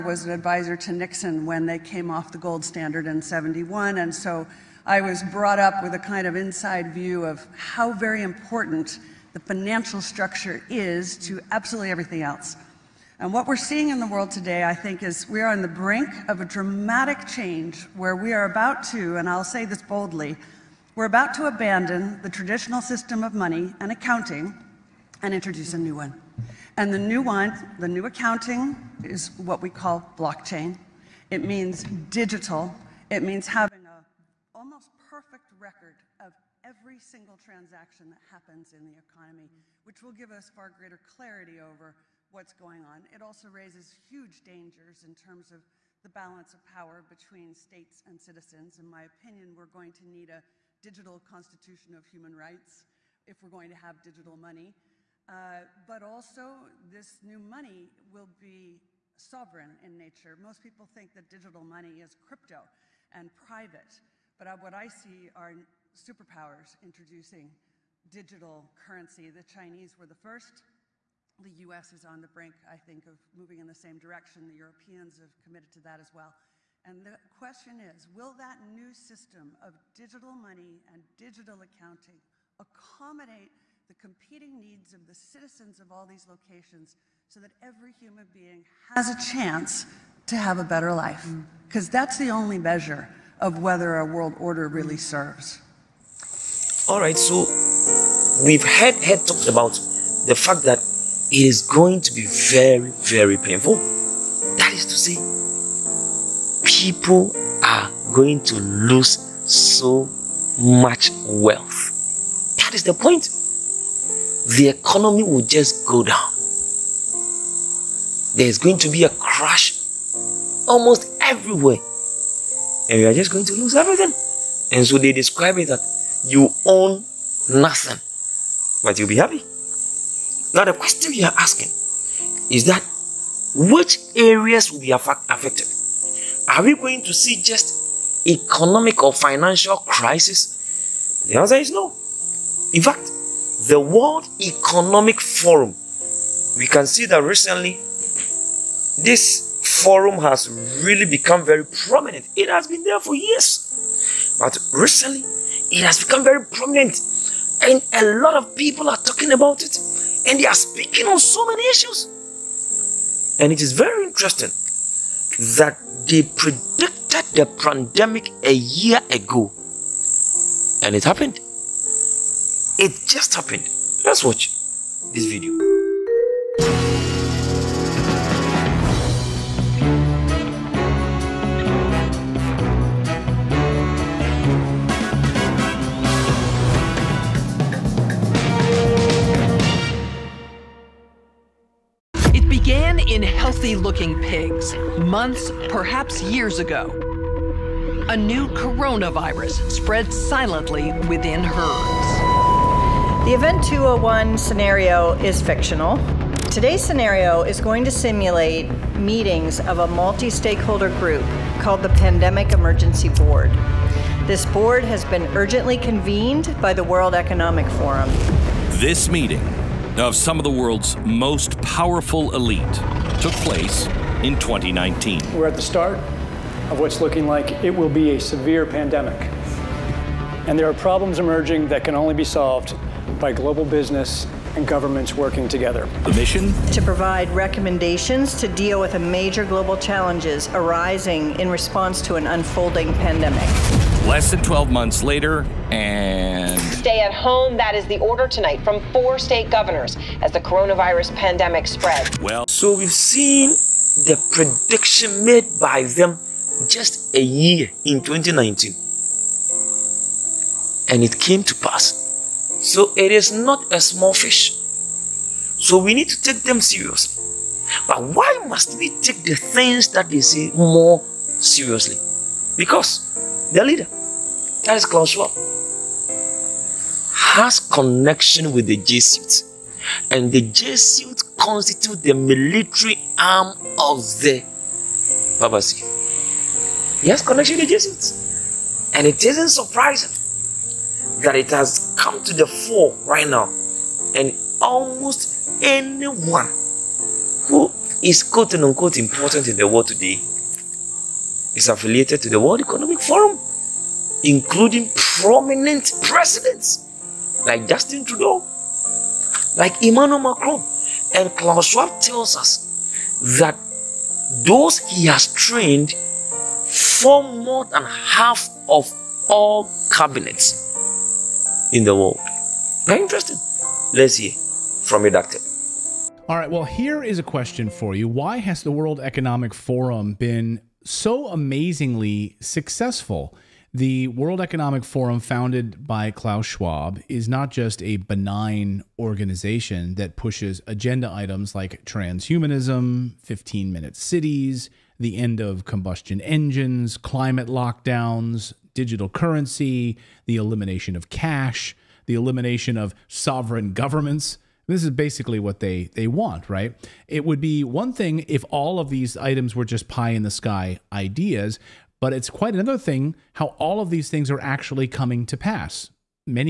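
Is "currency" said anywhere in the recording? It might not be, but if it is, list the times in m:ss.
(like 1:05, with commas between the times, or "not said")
1:08, 5:49.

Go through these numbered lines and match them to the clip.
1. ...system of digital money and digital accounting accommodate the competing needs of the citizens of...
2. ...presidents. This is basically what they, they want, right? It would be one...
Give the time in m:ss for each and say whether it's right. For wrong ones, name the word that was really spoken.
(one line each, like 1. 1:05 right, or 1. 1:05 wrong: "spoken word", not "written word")
1. 1:18 right
2. 5:53 wrong: "governments", not "presidents".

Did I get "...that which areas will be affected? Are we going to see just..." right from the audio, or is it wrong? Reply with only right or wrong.
right.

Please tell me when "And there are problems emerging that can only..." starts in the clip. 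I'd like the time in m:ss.
3:50.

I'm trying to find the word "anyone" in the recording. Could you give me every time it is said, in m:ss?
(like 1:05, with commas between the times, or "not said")
4:55.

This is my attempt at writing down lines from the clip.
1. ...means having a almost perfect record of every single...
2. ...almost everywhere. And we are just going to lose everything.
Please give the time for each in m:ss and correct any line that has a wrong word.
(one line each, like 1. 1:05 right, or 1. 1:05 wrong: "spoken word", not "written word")
1. 0:33 right
2. 2:00 right.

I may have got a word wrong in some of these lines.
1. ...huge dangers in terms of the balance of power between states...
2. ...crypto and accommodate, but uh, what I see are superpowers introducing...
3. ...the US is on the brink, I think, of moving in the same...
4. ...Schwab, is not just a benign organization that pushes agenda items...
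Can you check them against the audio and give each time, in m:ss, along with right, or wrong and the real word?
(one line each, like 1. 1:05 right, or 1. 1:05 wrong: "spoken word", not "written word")
1. 0:44 right
2. 1:02 wrong: "private", not "accommodate"
3. 1:11 right
4. 5:36 right.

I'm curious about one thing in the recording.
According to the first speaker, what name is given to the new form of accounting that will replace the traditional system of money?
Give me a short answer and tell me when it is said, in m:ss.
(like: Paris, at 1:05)
blockchain, at 0:30.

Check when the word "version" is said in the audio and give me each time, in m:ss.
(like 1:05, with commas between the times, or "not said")
not said.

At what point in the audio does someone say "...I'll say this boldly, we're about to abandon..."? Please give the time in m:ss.
0:19.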